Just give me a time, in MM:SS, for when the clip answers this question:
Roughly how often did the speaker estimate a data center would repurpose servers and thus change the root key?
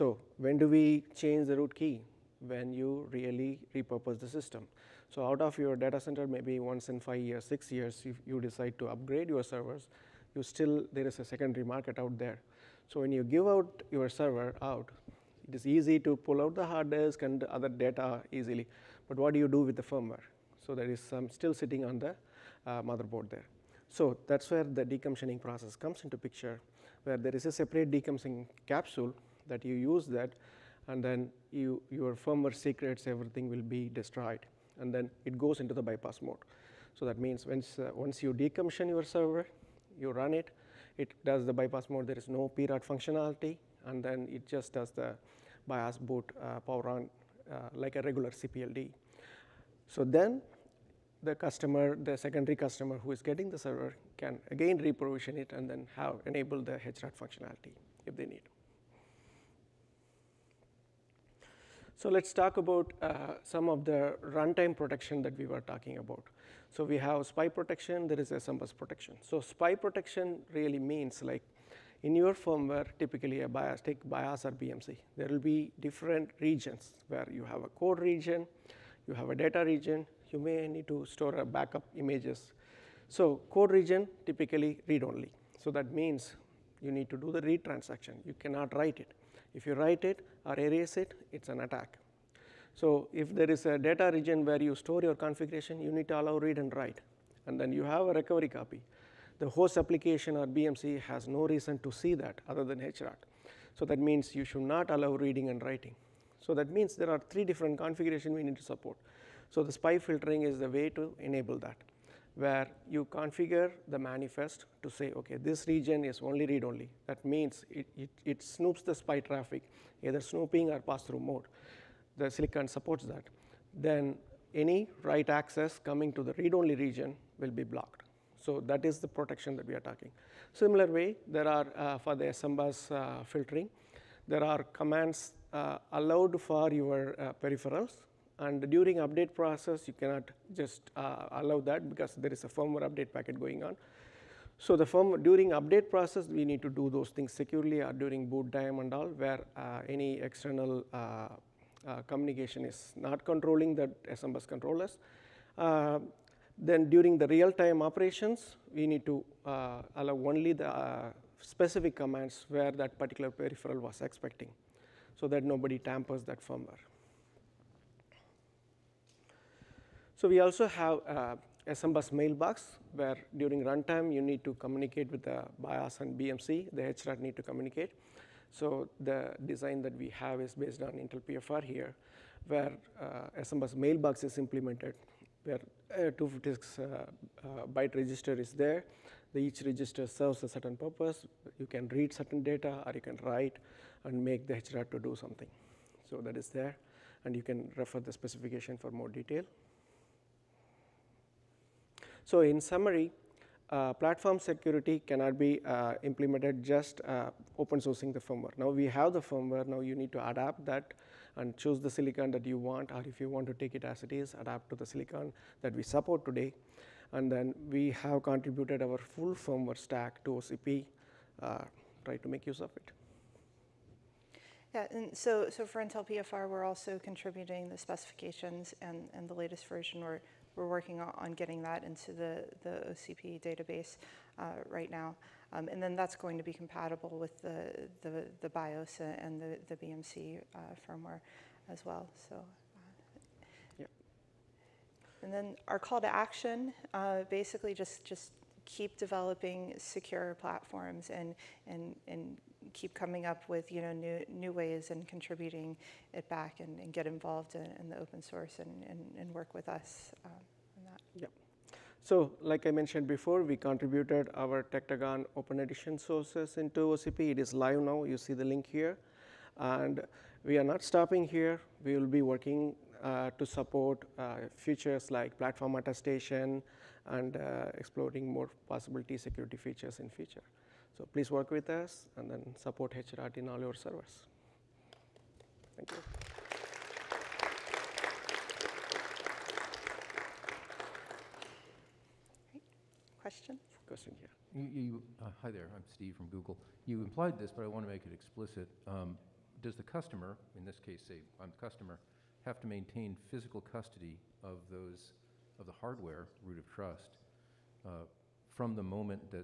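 00:06.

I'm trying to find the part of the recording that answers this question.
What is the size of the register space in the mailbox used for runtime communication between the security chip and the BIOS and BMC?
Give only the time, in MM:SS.
03:06.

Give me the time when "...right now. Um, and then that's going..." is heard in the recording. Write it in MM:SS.
03:54.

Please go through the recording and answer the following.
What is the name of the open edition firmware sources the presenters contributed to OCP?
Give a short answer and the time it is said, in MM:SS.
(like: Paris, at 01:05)
Tectagon, at 04:24.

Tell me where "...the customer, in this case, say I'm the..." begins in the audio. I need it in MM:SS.
04:59.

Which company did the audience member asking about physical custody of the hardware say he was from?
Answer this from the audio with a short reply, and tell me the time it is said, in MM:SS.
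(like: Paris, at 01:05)
Google, at 04:56.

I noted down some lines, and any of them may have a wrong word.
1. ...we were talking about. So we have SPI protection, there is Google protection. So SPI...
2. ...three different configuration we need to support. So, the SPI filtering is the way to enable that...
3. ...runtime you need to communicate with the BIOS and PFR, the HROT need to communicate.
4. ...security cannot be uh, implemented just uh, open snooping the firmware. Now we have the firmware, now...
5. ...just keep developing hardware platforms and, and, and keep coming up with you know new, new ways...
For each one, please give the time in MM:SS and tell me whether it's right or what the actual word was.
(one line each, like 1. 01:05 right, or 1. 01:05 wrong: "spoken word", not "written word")
1. 01:05 wrong: "SMBus", not "Google"
2. 01:47 right
3. 02:53 wrong: "BMC", not "PFR"
4. 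03:24 wrong: "sourcing", not "snooping"
5. 04:08 wrong: "secure", not "hardware".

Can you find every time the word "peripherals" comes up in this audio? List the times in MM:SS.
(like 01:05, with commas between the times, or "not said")
02:17, 02:43.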